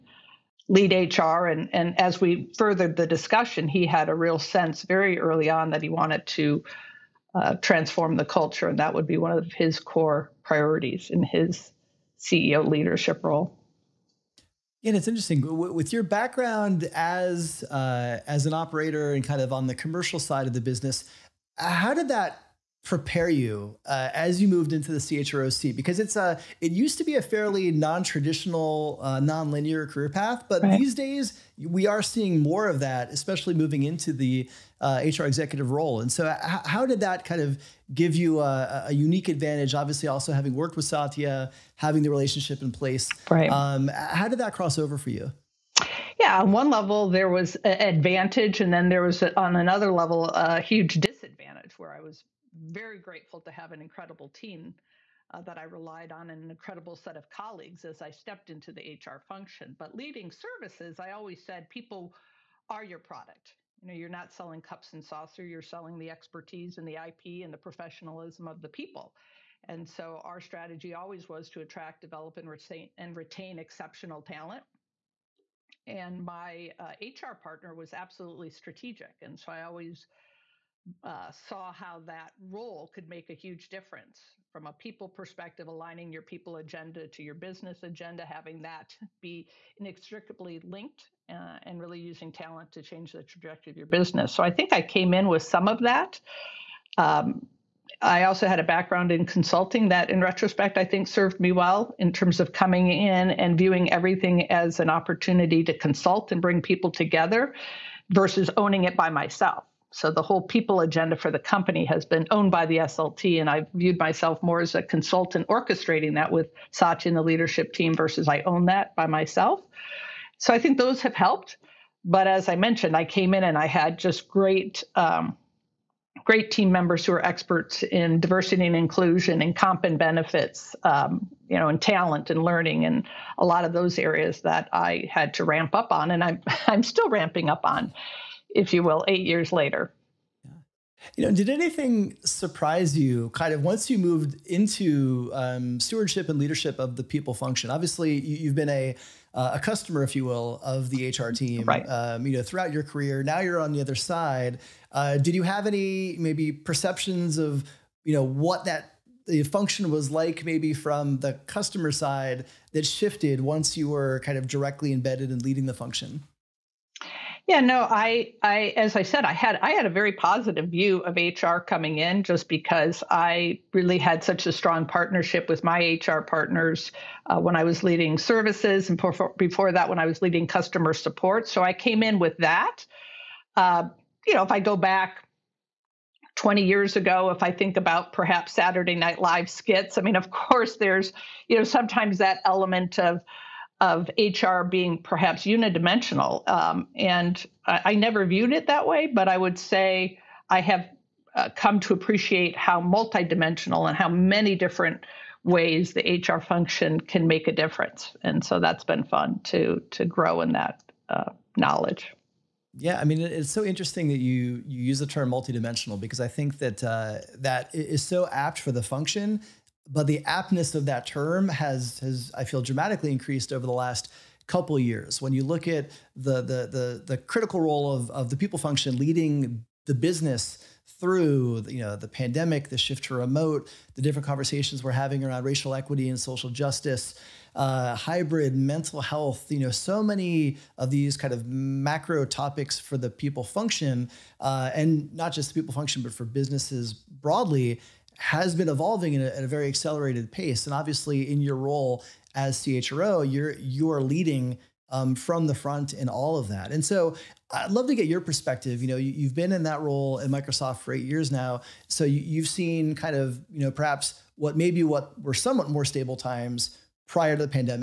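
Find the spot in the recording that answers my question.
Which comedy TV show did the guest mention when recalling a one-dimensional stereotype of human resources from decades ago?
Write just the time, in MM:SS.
03:08.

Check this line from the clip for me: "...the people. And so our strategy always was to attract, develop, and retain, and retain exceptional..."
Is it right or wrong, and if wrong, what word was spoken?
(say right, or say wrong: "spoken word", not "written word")
right.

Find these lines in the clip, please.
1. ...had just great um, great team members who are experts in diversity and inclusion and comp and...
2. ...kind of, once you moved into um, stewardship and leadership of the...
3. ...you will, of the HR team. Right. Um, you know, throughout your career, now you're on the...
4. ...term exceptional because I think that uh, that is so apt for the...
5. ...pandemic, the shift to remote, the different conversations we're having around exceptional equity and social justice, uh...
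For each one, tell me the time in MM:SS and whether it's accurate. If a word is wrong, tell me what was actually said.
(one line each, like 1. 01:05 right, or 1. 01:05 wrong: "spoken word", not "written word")
1. 02:03 right
2. 02:23 right
3. 02:30 right
4. 03:35 wrong: "multidimensional", not "exceptional"
5. 03:52 wrong: "racial", not "exceptional".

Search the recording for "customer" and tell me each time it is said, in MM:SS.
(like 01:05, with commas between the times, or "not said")
02:29, 02:41, 03:00.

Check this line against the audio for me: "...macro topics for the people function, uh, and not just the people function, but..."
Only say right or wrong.
right.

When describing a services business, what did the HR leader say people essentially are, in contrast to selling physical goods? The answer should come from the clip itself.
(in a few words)
your product.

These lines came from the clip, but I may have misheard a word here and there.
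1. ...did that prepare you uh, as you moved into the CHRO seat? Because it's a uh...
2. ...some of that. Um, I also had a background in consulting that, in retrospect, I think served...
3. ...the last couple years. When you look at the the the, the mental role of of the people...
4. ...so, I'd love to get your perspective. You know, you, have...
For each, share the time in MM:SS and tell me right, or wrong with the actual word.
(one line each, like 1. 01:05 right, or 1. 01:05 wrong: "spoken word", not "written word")
1. 00:21 right
2. 01:35 right
3. 03:43 wrong: "critical", not "mental"
4. 04:16 right.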